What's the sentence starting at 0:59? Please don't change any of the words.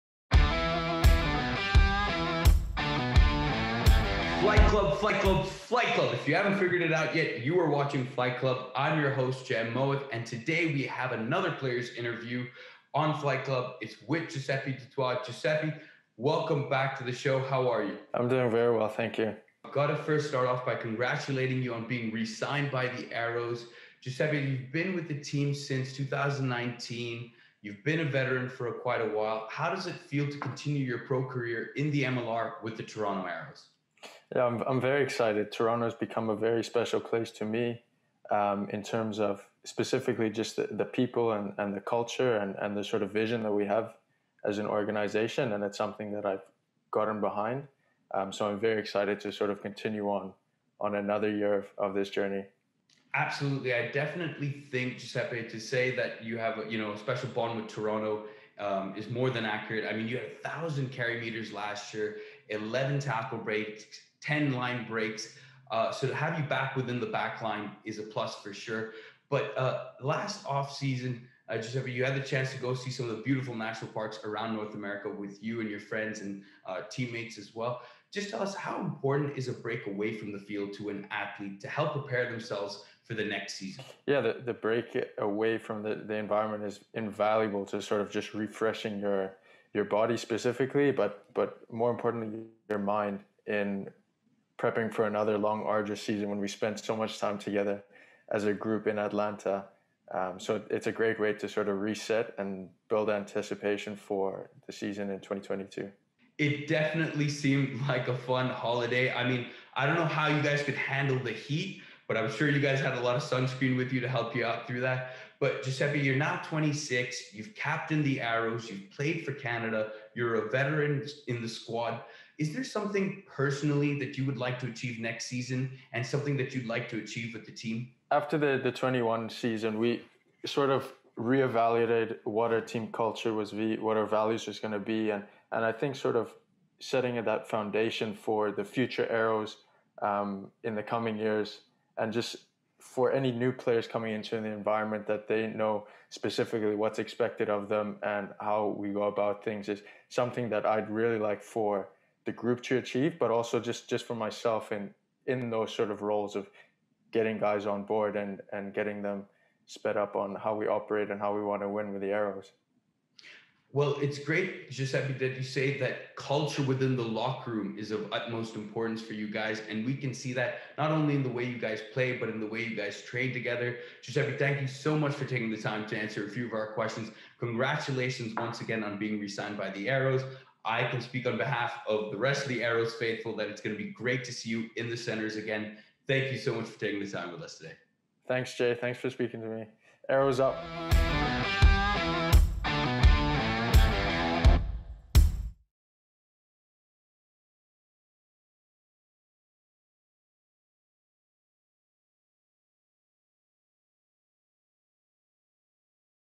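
I mean, you had a 1,000 carry meters last year, 11 tackle breaks, 10 line breaks.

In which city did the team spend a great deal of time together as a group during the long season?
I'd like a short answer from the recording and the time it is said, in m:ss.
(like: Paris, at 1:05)
Atlanta, at 1:38.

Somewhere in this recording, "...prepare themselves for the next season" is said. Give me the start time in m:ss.
1:21.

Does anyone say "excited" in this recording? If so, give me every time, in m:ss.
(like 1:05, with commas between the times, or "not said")
0:35, 0:48.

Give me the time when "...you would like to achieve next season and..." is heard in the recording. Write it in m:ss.
2:04.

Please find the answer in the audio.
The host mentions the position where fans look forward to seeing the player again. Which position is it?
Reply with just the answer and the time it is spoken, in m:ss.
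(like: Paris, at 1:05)
Centers, at 3:04.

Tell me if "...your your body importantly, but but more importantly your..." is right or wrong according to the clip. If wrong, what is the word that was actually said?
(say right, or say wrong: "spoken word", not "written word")
wrong: "specifically", not "importantly".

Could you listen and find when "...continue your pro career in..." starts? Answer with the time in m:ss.
0:30.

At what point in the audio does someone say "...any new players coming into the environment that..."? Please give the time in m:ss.
2:23.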